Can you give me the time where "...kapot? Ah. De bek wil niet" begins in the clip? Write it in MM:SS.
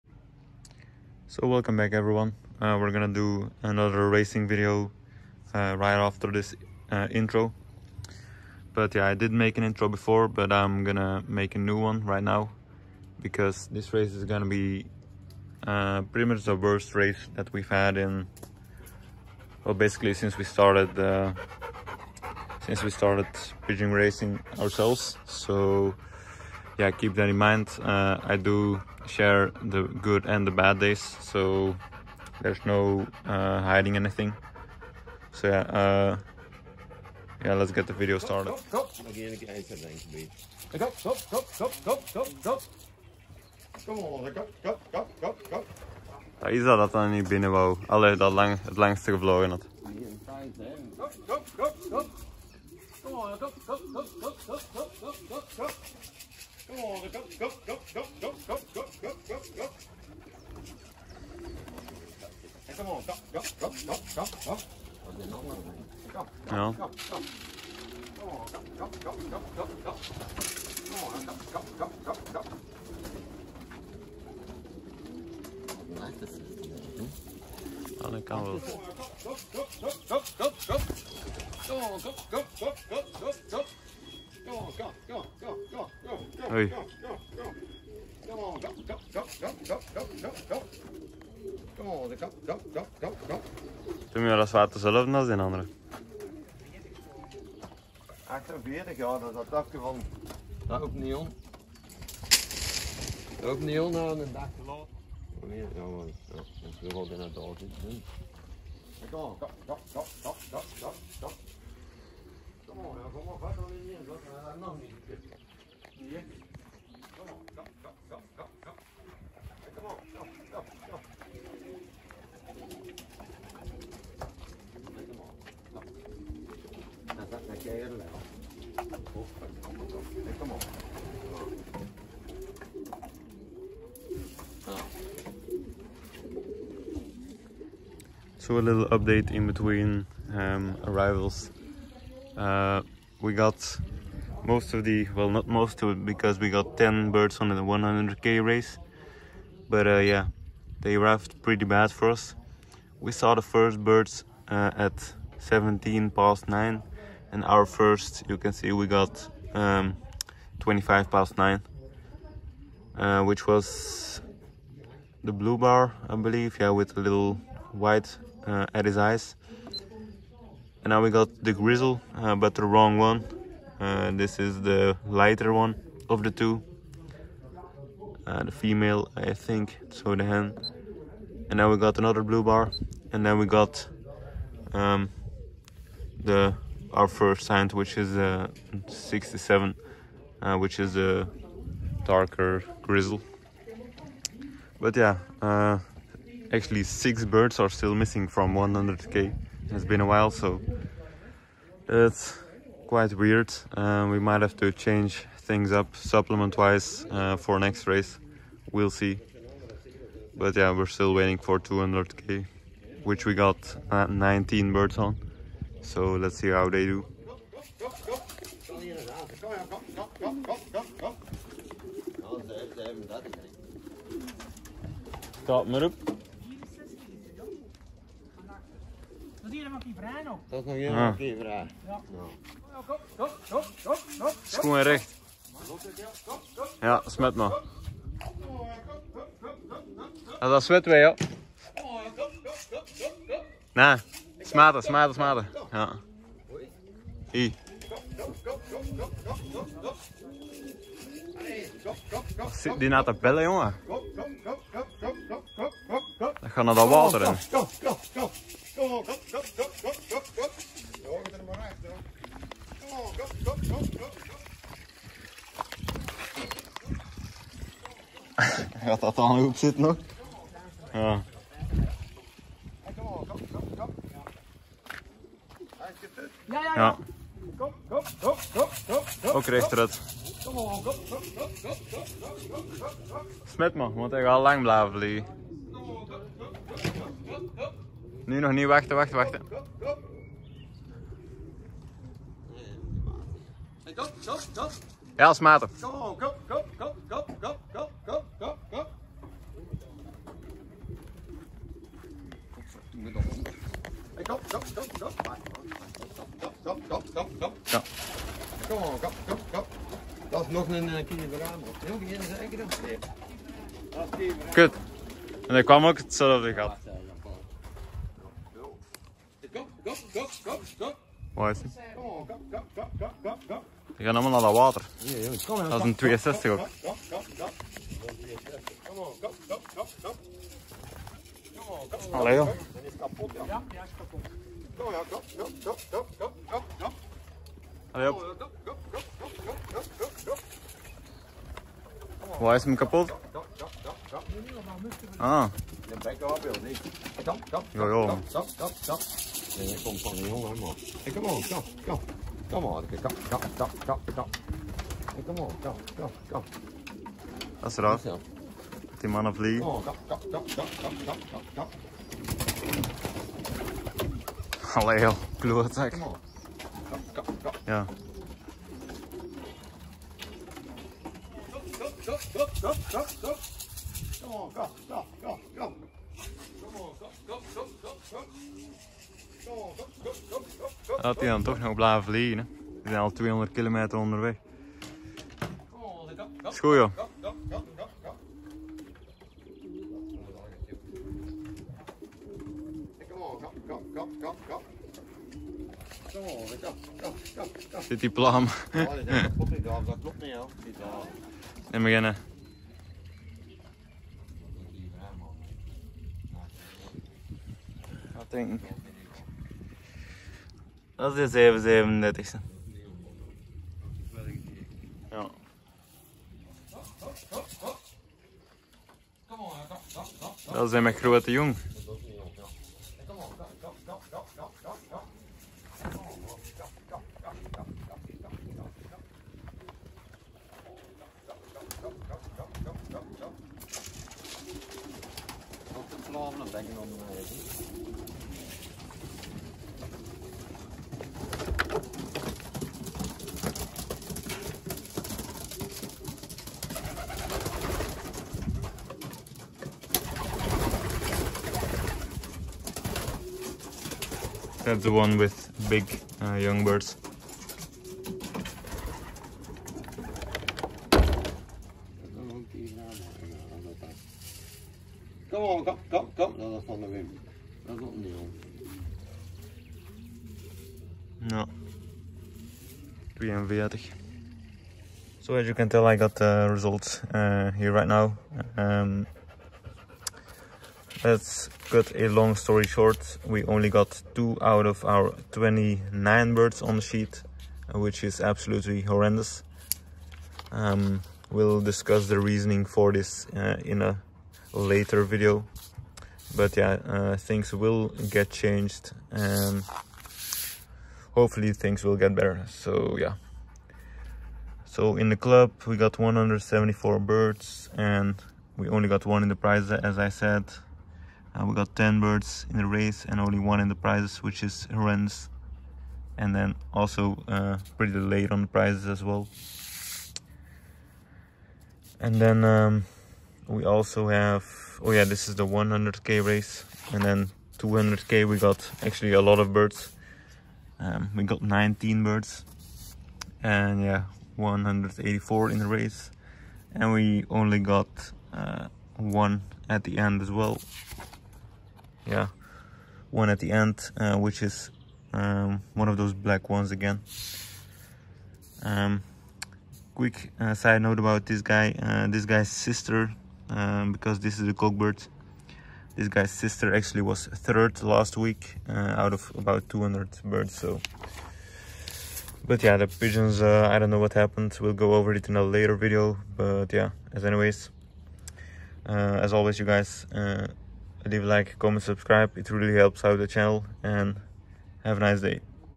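05:42.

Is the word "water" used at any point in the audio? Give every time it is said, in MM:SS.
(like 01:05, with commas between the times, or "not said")
04:16, 05:24.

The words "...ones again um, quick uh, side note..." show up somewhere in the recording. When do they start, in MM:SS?
09:06.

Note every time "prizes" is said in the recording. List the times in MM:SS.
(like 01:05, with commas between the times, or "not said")
08:29, 08:33, 08:38.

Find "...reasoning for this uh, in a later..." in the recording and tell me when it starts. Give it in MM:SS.
08:12.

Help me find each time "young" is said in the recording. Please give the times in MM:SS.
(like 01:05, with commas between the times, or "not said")
07:36.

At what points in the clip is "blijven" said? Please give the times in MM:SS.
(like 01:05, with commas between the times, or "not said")
04:44, 06:21.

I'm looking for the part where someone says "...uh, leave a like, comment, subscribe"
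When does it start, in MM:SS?
09:30.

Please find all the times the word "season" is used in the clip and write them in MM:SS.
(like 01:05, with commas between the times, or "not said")
not said.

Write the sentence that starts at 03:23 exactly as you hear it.
Uh, we might have to change things up supplement-wise uh, for next race.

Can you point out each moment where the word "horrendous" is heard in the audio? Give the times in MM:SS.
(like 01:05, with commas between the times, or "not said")
08:08, 08:34.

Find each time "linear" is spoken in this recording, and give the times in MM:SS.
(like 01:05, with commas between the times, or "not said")
not said.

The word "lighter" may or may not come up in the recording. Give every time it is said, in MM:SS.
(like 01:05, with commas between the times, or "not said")
02:55.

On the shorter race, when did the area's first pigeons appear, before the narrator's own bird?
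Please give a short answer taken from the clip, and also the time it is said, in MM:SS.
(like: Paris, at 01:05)
9:17, at 02:35.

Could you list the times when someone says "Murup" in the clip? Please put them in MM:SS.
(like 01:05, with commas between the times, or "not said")
03:45.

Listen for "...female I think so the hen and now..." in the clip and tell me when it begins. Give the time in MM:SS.
02:58.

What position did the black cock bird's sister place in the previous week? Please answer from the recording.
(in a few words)
3rd.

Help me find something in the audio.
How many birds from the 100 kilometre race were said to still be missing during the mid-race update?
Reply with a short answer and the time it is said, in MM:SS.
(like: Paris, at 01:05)
6, at 03:16.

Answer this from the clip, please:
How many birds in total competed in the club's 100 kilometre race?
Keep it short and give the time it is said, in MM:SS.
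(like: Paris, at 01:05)
174, at 08:25.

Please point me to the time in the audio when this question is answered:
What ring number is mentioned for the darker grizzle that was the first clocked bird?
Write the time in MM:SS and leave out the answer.
03:08.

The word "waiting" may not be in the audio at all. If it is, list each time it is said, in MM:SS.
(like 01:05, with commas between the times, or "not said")
03:31.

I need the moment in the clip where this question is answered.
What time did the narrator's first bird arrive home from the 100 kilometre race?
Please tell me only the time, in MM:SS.
02:40.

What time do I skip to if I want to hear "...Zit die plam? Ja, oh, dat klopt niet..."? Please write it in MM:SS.
06:37.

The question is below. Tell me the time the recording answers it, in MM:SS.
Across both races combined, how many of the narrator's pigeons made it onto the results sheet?
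08:04.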